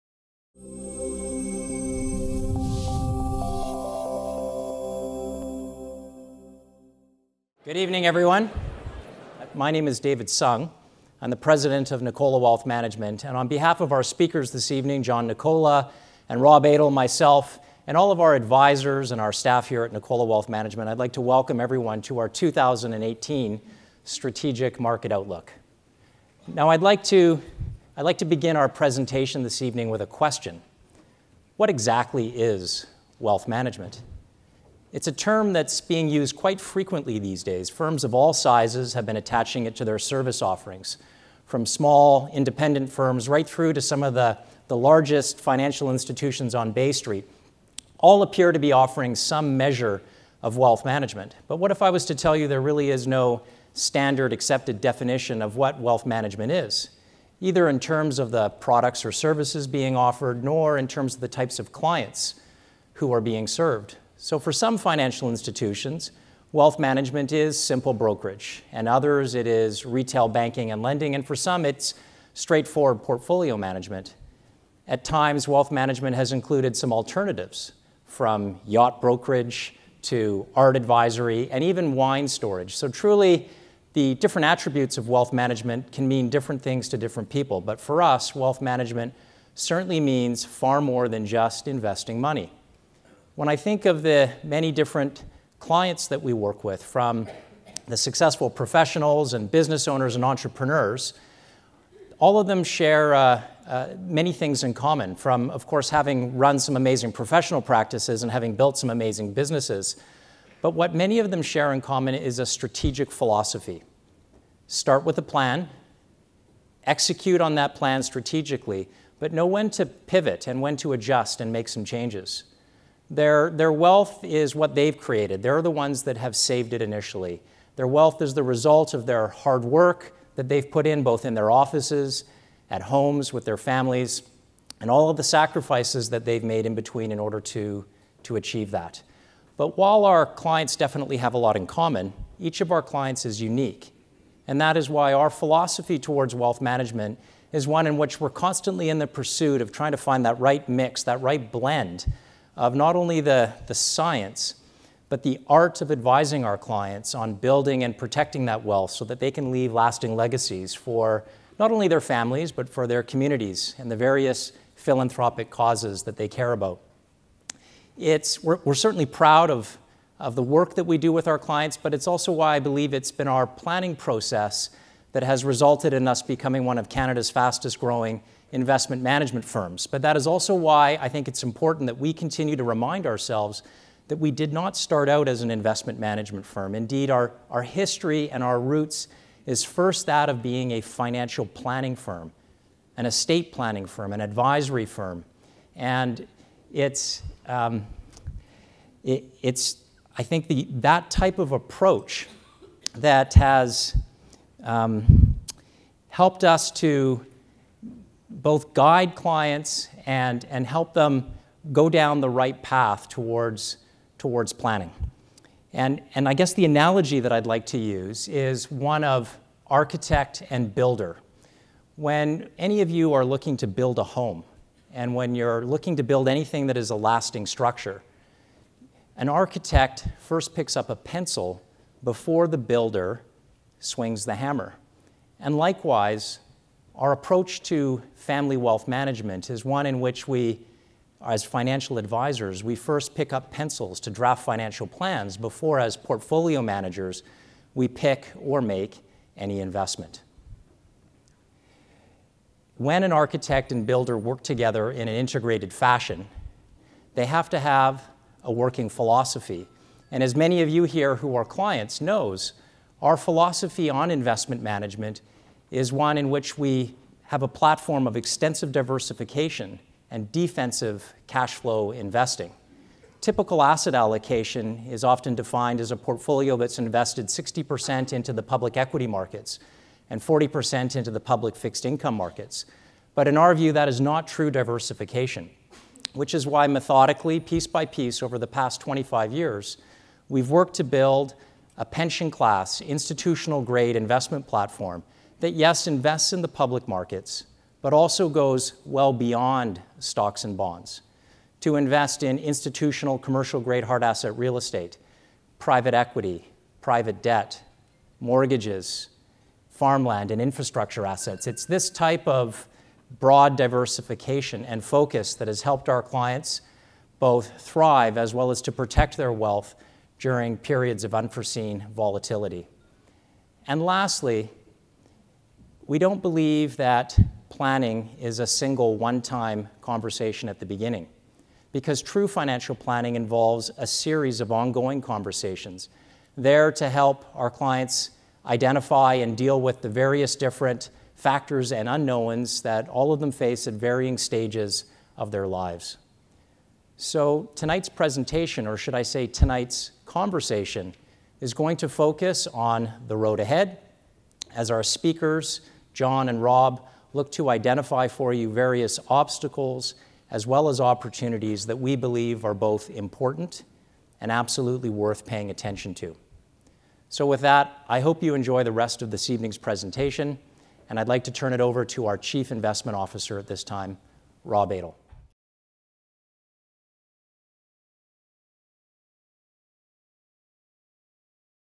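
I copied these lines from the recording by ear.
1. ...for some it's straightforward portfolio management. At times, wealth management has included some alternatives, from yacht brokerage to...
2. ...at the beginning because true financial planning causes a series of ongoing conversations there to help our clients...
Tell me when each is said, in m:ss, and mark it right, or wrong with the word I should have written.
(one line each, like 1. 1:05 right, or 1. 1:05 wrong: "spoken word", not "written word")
1. 1:11 right
2. 5:30 wrong: "involves", not "causes".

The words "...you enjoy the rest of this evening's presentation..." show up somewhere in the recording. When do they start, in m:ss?
6:08.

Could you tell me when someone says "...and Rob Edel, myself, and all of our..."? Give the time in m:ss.
0:16.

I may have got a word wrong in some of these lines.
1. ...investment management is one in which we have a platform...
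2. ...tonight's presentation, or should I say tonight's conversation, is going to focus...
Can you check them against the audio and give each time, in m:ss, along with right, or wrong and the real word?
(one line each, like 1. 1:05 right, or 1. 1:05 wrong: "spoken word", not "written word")
1. 4:24 right
2. 5:47 right.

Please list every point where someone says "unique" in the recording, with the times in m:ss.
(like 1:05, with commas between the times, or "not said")
2:23.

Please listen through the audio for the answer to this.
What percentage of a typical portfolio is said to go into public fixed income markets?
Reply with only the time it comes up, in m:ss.
4:40.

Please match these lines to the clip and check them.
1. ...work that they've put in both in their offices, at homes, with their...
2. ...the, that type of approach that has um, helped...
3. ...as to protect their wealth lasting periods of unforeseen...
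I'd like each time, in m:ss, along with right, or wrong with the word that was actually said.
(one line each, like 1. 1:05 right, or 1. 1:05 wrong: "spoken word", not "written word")
1. 2:09 right
2. 3:20 right
3. 5:18 wrong: "during", not "lasting".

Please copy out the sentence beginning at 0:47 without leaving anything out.
All appear to be offering some measure of wealth management.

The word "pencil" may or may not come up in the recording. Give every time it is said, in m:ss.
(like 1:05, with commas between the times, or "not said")
3:50, 4:03.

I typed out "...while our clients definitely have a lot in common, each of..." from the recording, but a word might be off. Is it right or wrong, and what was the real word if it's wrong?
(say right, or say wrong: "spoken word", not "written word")
right.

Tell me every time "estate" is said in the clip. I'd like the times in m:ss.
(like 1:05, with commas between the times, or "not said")
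3:13, 5:04.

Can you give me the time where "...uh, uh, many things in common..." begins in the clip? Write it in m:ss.
1:43.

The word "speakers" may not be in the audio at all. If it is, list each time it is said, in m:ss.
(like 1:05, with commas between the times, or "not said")
0:14, 5:54.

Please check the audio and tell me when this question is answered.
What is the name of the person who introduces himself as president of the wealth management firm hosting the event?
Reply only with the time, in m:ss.
0:10.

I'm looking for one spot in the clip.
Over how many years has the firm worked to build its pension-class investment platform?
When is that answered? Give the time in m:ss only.
4:48.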